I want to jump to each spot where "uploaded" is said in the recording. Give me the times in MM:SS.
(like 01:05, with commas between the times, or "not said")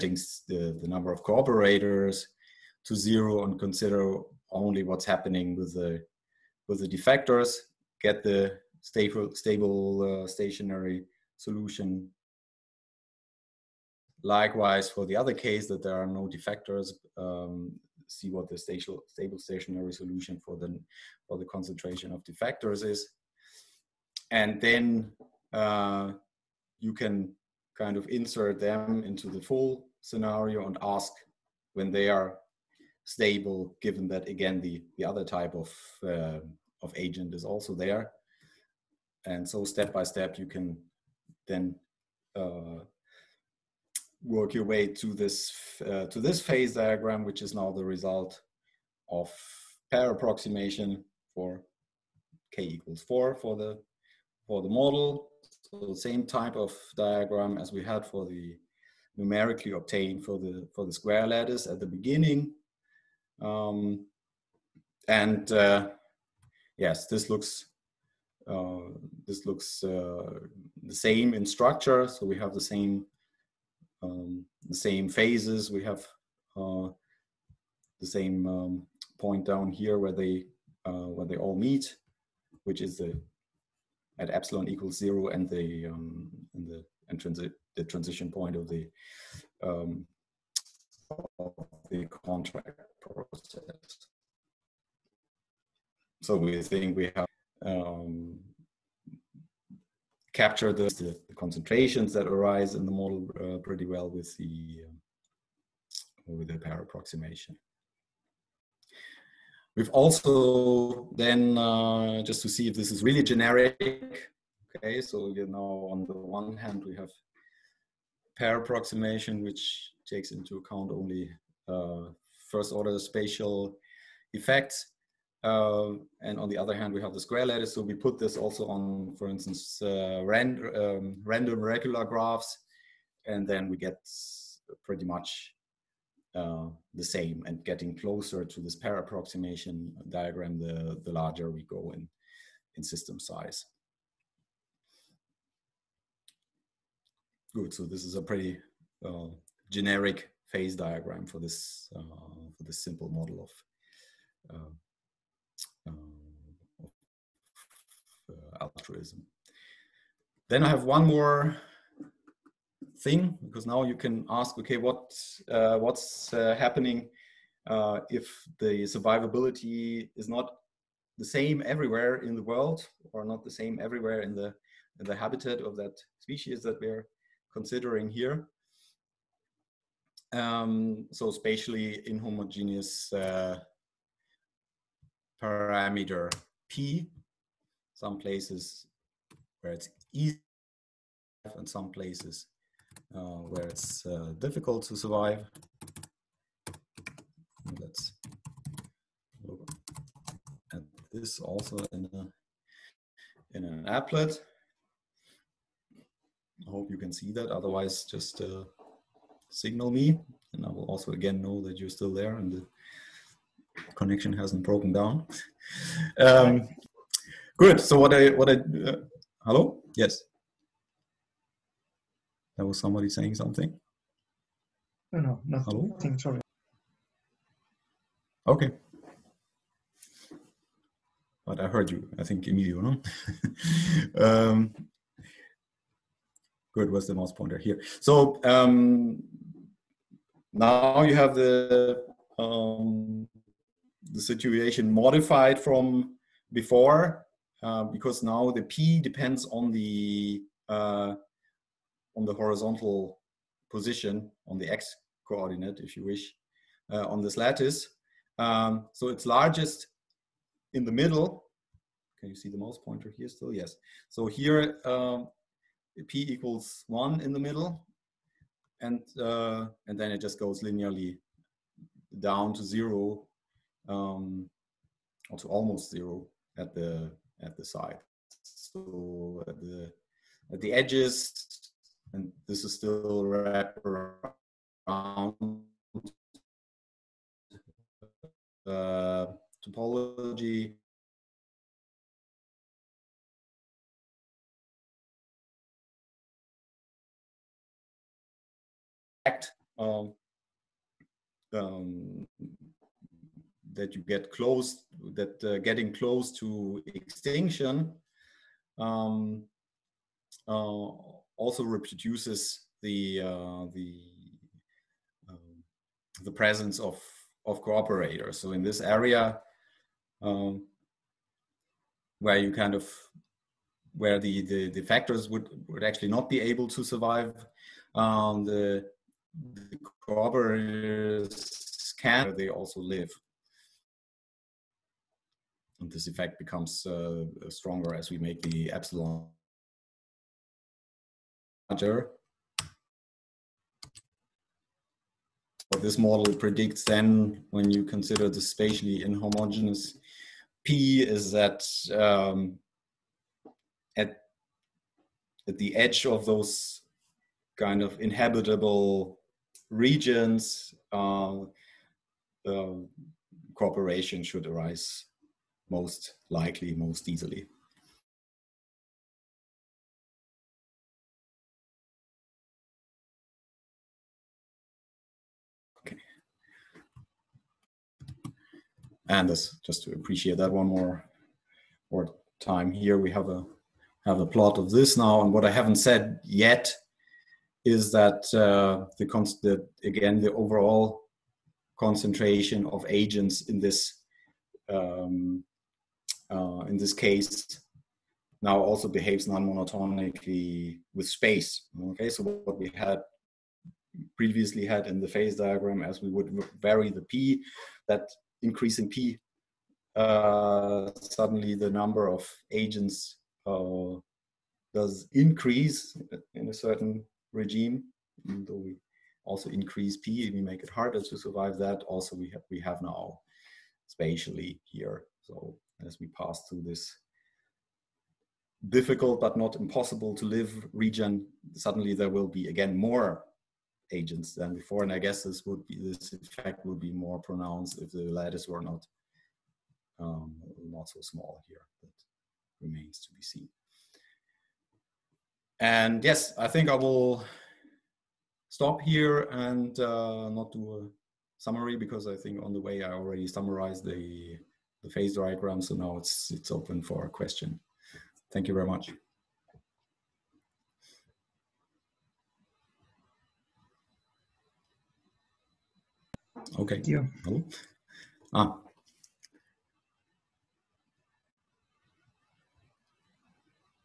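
not said.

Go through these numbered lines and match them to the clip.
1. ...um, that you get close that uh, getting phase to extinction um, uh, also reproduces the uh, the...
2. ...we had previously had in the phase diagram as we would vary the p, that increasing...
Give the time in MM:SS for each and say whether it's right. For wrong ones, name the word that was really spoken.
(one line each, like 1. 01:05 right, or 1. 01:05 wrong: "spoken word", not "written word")
1. 05:01 wrong: "close", not "phase"
2. 06:42 right.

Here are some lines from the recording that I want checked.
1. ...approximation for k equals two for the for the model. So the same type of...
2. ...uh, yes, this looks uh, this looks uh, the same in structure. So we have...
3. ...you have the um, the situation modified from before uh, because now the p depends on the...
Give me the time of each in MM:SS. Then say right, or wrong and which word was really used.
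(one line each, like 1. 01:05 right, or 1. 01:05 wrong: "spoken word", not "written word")
1. 00:50 wrong: "four", not "two"
2. 01:05 right
3. 04:01 right.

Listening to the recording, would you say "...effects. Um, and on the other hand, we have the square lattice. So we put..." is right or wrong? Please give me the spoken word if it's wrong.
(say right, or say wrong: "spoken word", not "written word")
right.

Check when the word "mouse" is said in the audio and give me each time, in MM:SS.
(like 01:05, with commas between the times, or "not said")
03:57, 04:22.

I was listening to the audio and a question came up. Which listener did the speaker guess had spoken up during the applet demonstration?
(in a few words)
Emilio.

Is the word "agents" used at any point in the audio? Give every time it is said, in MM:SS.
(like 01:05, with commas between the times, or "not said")
00:36, 06:32, 06:52, 07:13.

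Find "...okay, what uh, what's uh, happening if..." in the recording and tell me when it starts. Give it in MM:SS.
02:44.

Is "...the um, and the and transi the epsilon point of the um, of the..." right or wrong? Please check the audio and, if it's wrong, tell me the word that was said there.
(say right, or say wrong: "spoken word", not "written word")
wrong: "transition", not "epsilon".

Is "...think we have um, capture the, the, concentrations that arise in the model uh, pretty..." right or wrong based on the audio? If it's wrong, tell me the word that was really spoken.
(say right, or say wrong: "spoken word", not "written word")
right.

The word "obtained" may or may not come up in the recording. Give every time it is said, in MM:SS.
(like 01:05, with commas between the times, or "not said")
00:59.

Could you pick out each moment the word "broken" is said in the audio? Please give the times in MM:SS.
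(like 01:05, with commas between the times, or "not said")
03:34.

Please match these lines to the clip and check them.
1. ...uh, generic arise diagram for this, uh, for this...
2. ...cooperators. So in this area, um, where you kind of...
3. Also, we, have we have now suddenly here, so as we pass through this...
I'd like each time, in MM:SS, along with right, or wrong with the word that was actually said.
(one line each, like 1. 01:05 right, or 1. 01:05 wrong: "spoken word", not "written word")
1. 02:29 wrong: "phase", not "arise"
2. 05:17 right
3. 07:01 wrong: "spatially", not "suddenly".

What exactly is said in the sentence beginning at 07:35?
So now it's, it's open for a question.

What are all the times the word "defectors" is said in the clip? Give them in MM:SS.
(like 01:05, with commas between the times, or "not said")
00:06, 00:16, 00:22.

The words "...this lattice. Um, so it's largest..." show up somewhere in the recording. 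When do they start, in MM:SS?
04:17.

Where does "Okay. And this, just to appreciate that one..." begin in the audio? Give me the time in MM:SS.
06:15.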